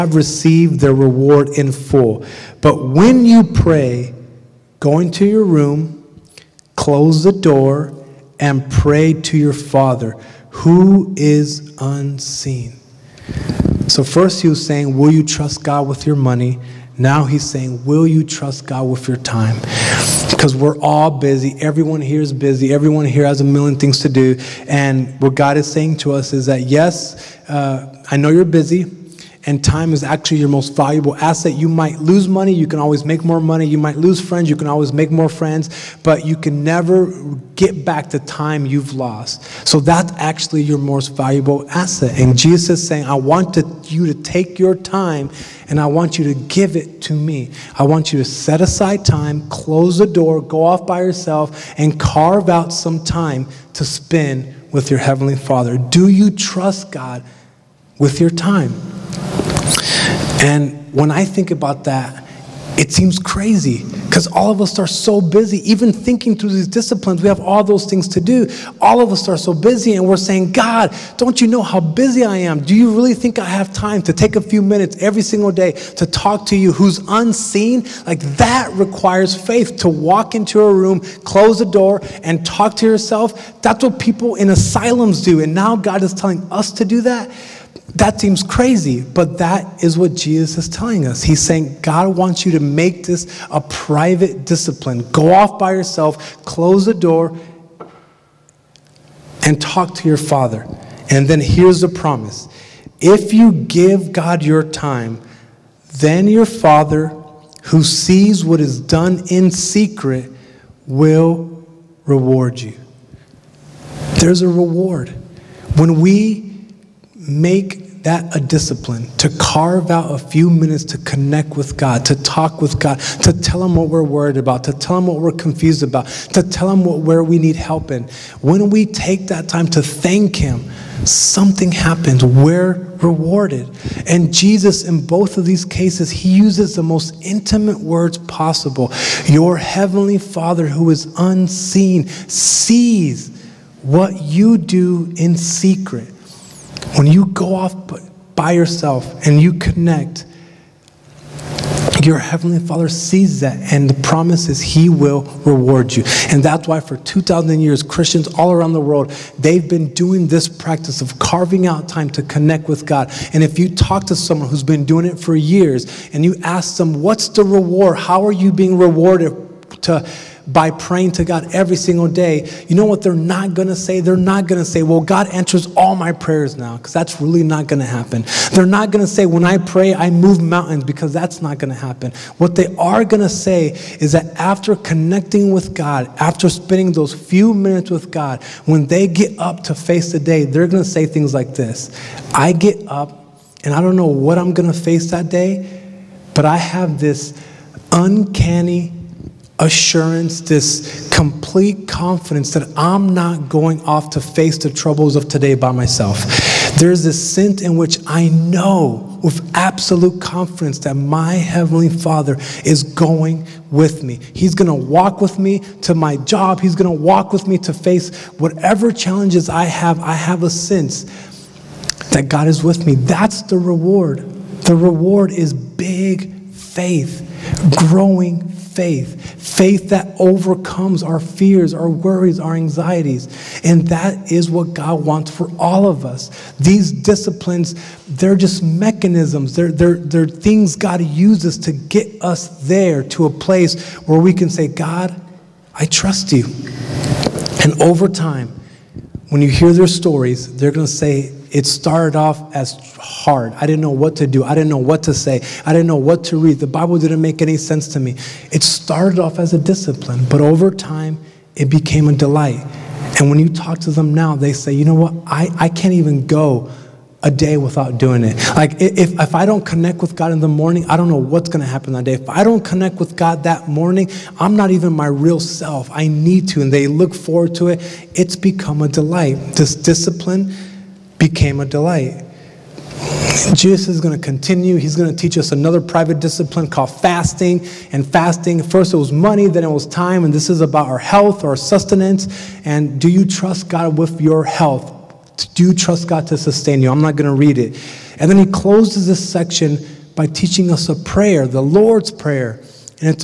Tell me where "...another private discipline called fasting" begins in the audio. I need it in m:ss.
4:45.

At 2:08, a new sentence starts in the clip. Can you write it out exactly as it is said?
When we take that time to thank Him, something happens.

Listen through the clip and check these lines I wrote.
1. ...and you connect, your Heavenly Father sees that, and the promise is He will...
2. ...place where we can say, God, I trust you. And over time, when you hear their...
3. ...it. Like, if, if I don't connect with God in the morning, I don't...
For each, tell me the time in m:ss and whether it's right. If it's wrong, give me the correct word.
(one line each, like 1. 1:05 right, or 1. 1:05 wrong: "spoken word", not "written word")
1. 2:29 right
2. 4:03 right
3. 4:28 right.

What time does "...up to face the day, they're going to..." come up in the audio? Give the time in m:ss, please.
3:09.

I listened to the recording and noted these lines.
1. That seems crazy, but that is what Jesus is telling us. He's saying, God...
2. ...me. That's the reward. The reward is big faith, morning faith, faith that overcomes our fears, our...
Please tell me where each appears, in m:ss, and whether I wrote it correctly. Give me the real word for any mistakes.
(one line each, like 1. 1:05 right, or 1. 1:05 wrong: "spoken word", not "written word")
1. 1:27 right
2. 3:42 wrong: "growing", not "morning".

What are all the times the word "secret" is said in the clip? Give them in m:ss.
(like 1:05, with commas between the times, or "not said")
1:49, 2:25.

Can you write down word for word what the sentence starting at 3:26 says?
There's this sense in which I know with absolute confidence that my Heavenly Father is going with me.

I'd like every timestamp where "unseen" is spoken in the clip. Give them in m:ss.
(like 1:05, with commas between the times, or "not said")
0:11, 1:17, 2:21.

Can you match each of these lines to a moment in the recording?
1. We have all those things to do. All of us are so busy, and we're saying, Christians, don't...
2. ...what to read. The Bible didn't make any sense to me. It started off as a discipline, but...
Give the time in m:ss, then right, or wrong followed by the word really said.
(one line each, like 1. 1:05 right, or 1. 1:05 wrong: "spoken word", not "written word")
1. 1:07 wrong: "God", not "Christians"
2. 4:15 right.